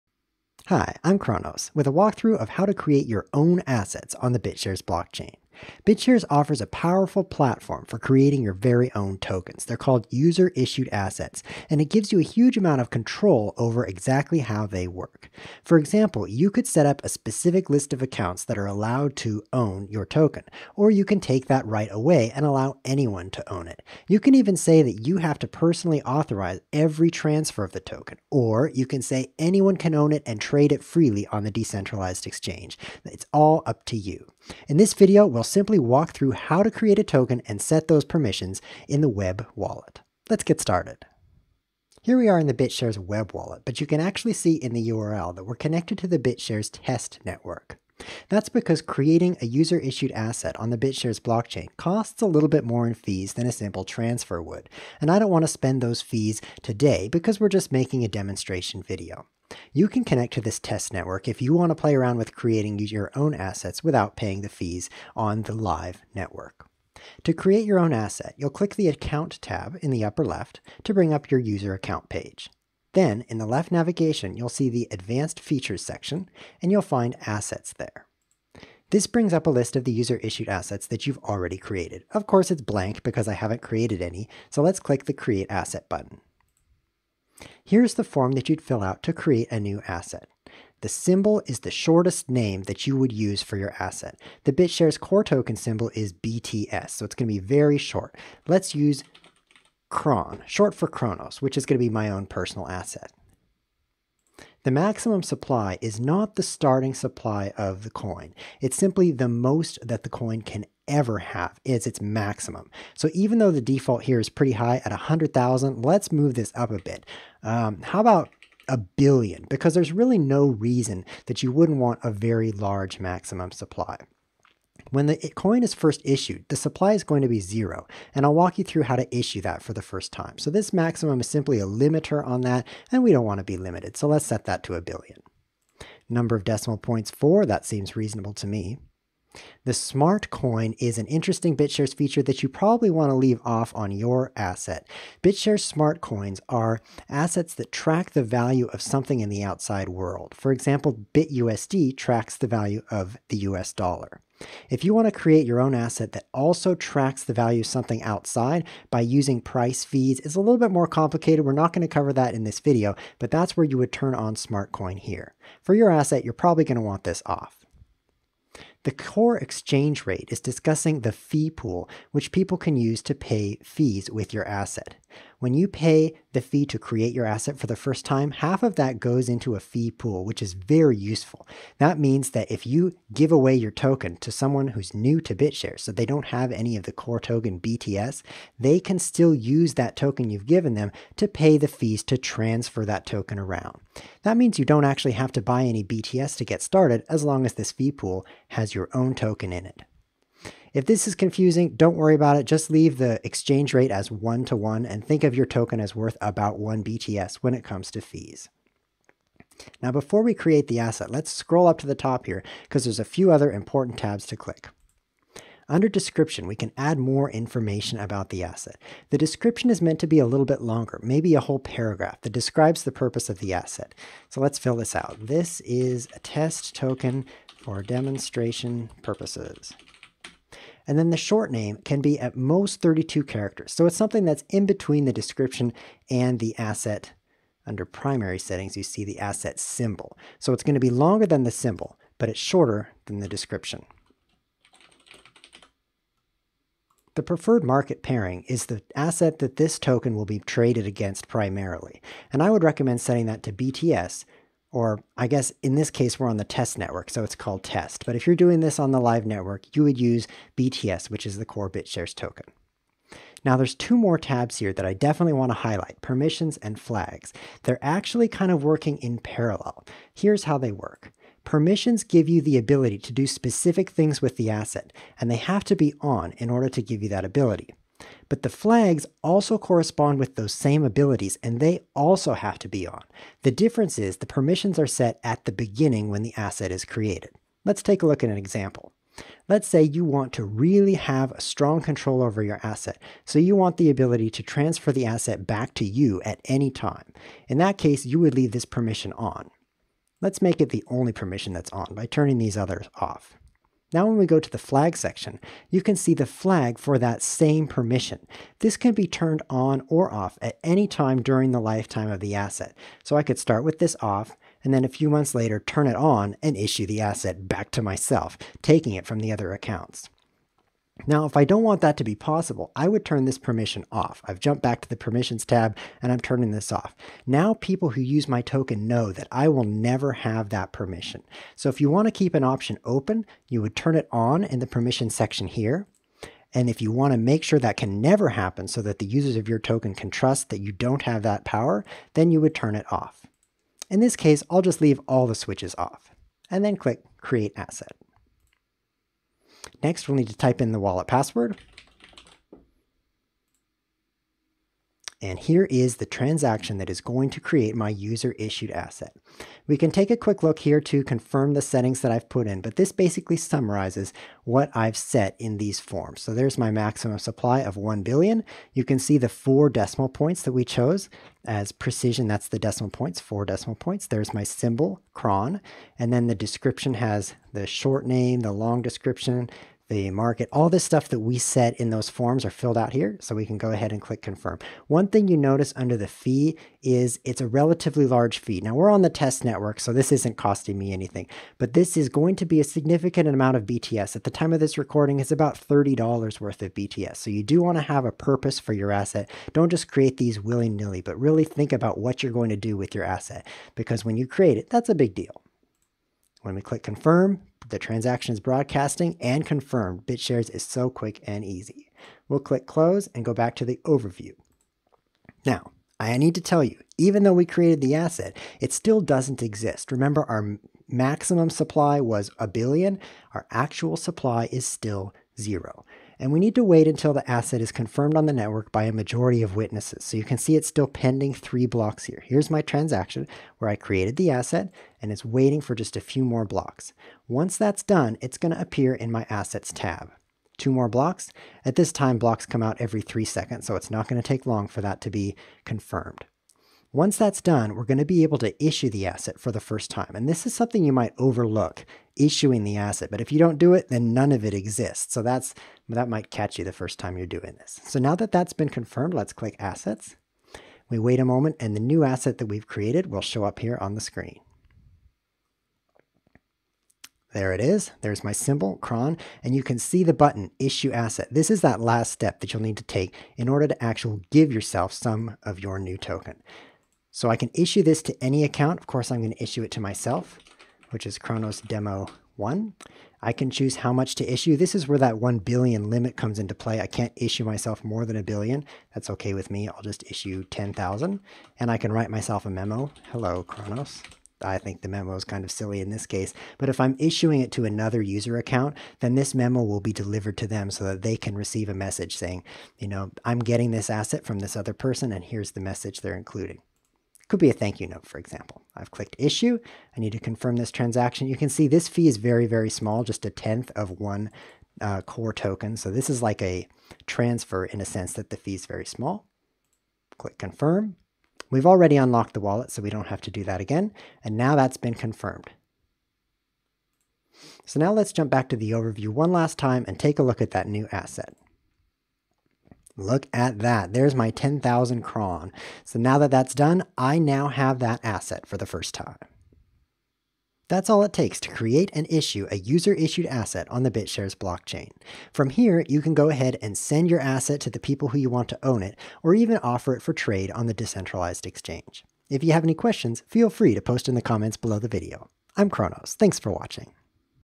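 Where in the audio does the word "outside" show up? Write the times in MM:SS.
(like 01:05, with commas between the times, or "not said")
02:29, 02:38.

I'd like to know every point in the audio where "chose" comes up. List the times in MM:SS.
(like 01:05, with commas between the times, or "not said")
06:10.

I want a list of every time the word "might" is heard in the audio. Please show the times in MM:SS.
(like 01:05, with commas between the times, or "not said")
07:30, 07:36.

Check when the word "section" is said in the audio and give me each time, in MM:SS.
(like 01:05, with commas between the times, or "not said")
01:15, 05:04, 05:35.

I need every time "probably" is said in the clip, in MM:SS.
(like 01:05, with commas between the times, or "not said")
02:22, 02:46.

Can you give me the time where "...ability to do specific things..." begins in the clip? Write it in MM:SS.
04:32.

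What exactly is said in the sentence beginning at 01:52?
So even though the default here is pretty high at 100,000, let's move this up a bit.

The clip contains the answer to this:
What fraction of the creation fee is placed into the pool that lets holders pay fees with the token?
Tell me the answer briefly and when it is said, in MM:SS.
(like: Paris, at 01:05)
Half, at 02:58.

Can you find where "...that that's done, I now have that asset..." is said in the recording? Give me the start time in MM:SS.
08:56.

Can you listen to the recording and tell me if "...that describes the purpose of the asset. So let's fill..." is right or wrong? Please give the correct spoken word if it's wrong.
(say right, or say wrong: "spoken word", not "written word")
right.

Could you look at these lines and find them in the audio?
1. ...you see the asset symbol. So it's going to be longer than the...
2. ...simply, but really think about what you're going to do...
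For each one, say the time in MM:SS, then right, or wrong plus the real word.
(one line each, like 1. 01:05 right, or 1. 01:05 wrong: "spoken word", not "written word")
1. 03:58 right
2. 06:40 wrong: "nilly", not "simply".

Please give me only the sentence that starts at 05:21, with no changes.
Now, if I don't want that to be possible, I would turn this permission off.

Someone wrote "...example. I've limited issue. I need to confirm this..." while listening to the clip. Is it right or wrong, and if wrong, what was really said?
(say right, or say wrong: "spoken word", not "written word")
wrong: "clicked", not "limited".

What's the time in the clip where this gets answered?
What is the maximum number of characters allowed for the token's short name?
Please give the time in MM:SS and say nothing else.
03:52.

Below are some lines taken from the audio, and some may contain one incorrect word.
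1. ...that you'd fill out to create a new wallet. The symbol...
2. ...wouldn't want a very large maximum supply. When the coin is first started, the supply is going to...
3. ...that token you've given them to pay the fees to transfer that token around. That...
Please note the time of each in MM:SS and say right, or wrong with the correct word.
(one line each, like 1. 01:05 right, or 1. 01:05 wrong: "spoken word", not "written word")
1. 01:28 wrong: "asset", not "wallet"
2. 02:01 wrong: "issued", not "started"
3. 03:09 right.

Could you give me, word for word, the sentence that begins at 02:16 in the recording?
Number of decimal points, four, that seems reasonable to me.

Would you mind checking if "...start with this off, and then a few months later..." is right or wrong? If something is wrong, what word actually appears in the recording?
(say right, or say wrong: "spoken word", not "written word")
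right.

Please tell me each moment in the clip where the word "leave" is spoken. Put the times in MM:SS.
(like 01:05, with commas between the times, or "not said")
02:23, 03:22, 04:58, 05:44.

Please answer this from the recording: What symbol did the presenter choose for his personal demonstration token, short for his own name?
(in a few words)
Kron.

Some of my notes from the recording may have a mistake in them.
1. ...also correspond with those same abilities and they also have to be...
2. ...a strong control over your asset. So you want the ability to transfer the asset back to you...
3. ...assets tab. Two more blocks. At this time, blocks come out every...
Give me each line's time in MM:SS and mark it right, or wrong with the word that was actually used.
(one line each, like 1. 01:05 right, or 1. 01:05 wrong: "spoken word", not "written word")
1. 04:39 right
2. 04:51 right
3. 07:19 right.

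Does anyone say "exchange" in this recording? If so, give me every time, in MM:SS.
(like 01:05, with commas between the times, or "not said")
00:32, 02:49, 03:23, 09:11.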